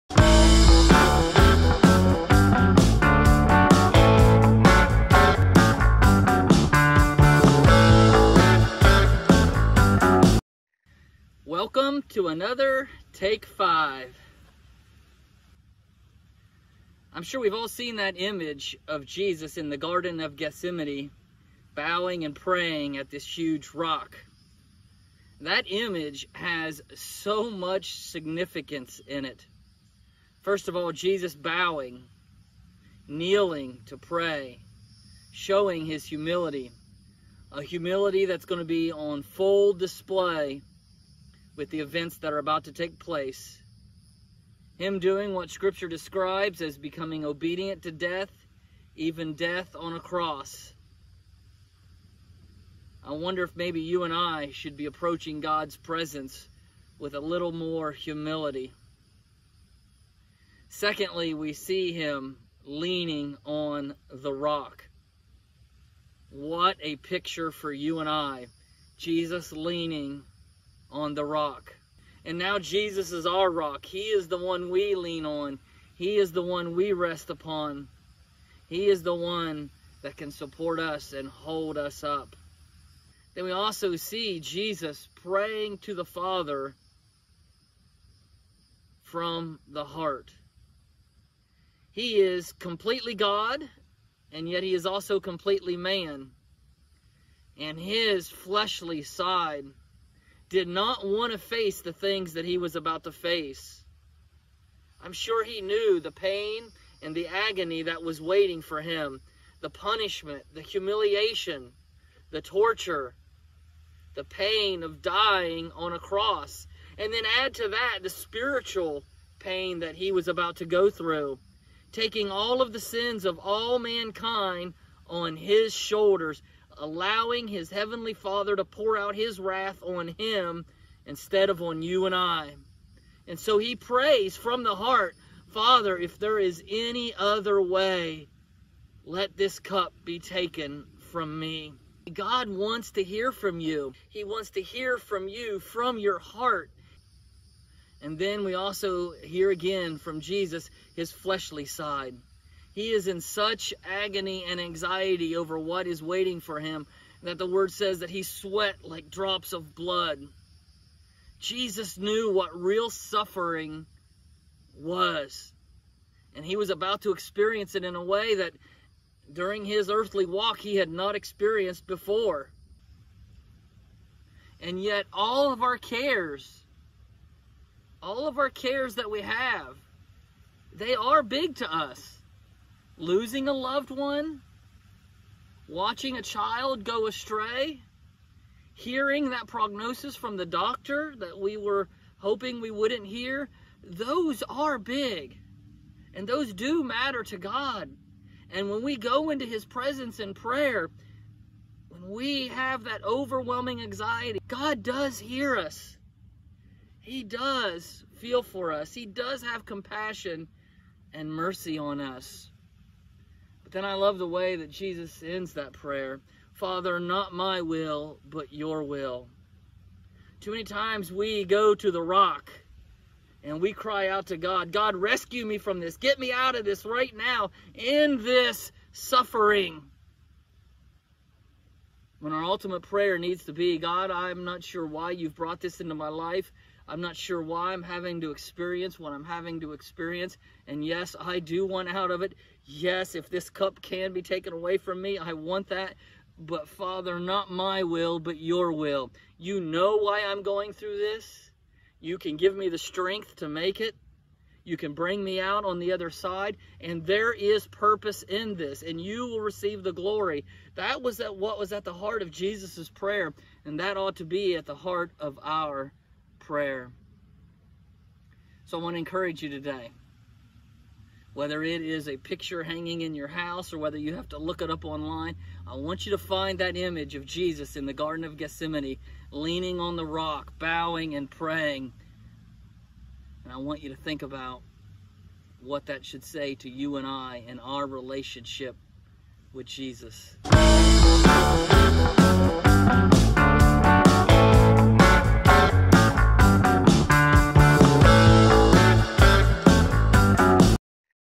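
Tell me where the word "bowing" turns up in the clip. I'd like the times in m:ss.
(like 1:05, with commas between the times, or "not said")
0:21, 0:31, 4:40.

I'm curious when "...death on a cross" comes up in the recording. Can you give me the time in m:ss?
0:49.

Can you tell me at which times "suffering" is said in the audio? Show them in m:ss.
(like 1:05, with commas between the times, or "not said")
2:42, 3:48.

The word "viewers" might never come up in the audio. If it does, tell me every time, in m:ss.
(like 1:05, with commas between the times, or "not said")
not said.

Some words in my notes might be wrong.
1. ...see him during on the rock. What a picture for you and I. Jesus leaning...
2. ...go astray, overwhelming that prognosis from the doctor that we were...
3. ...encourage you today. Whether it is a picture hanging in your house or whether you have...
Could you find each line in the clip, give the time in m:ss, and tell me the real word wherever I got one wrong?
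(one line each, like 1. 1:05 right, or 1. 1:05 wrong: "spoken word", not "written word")
1. 1:01 wrong: "leaning", not "during"
2. 3:06 wrong: "hearing", not "overwhelming"
3. 4:28 right.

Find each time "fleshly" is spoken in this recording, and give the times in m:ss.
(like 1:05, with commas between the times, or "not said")
1:38, 2:31.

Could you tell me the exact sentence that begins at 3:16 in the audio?
And those do matter to God.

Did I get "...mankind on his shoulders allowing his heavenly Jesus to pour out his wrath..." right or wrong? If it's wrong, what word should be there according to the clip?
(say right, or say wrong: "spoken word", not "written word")
wrong: "Father", not "Jesus".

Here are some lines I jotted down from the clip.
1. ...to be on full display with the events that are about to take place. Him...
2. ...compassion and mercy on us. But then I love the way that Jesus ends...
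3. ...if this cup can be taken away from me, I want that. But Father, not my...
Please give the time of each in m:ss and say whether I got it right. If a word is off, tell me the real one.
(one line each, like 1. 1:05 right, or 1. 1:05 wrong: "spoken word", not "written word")
1. 0:38 right
2. 3:29 right
3. 4:03 right.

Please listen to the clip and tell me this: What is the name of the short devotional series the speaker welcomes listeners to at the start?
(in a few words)
Take Five.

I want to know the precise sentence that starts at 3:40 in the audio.
Too many times we go to the rock and we cry out to God, God, rescue me from this.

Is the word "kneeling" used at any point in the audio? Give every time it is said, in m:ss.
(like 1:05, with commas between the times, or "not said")
0:33.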